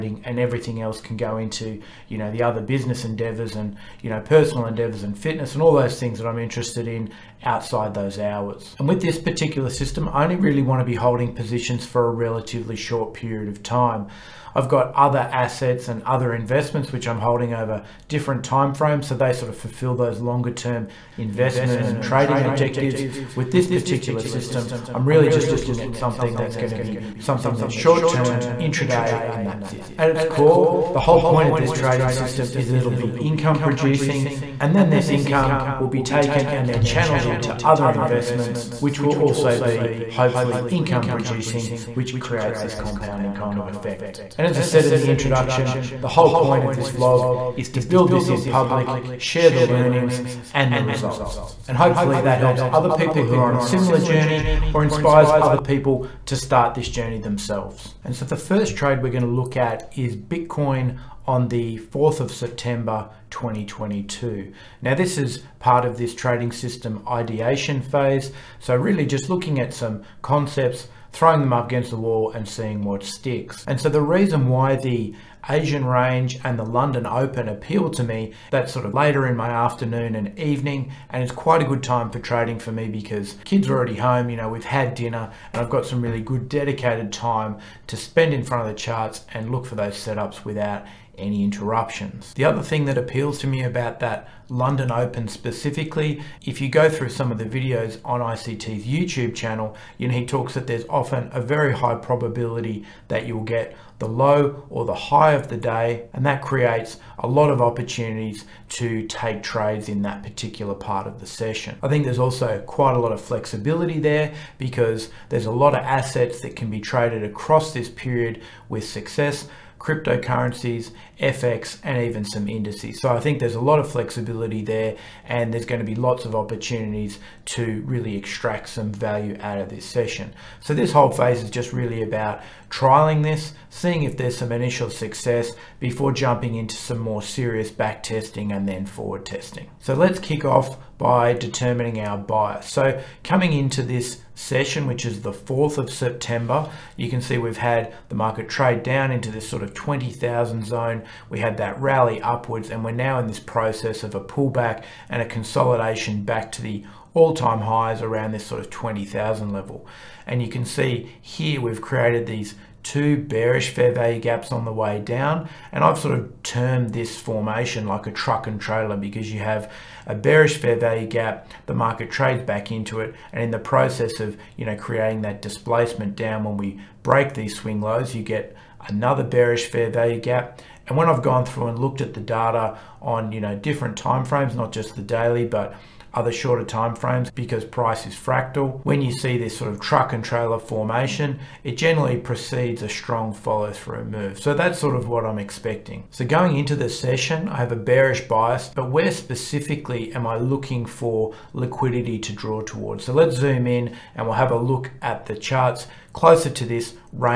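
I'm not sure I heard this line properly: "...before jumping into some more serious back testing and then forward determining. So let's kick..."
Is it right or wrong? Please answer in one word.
wrong.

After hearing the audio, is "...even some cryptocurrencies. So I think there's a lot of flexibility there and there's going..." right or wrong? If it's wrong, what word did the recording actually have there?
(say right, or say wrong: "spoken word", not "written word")
wrong: "indices", not "cryptocurrencies".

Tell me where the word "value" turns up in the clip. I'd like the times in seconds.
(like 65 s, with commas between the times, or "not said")
128 s, 163 s, 170 s, 179 s.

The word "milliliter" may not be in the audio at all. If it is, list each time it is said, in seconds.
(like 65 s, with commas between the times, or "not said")
not said.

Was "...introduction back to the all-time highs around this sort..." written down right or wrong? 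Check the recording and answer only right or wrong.
wrong.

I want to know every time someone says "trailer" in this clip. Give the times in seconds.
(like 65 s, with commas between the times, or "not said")
168 s, 190 s.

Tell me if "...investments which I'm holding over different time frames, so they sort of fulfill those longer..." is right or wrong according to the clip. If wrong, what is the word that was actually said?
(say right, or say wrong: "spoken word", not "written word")
right.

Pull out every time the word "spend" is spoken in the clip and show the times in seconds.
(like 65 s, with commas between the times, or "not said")
87 s.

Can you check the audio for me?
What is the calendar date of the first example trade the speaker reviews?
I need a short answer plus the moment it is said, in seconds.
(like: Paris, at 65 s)
4th of September 2022, at 61 s.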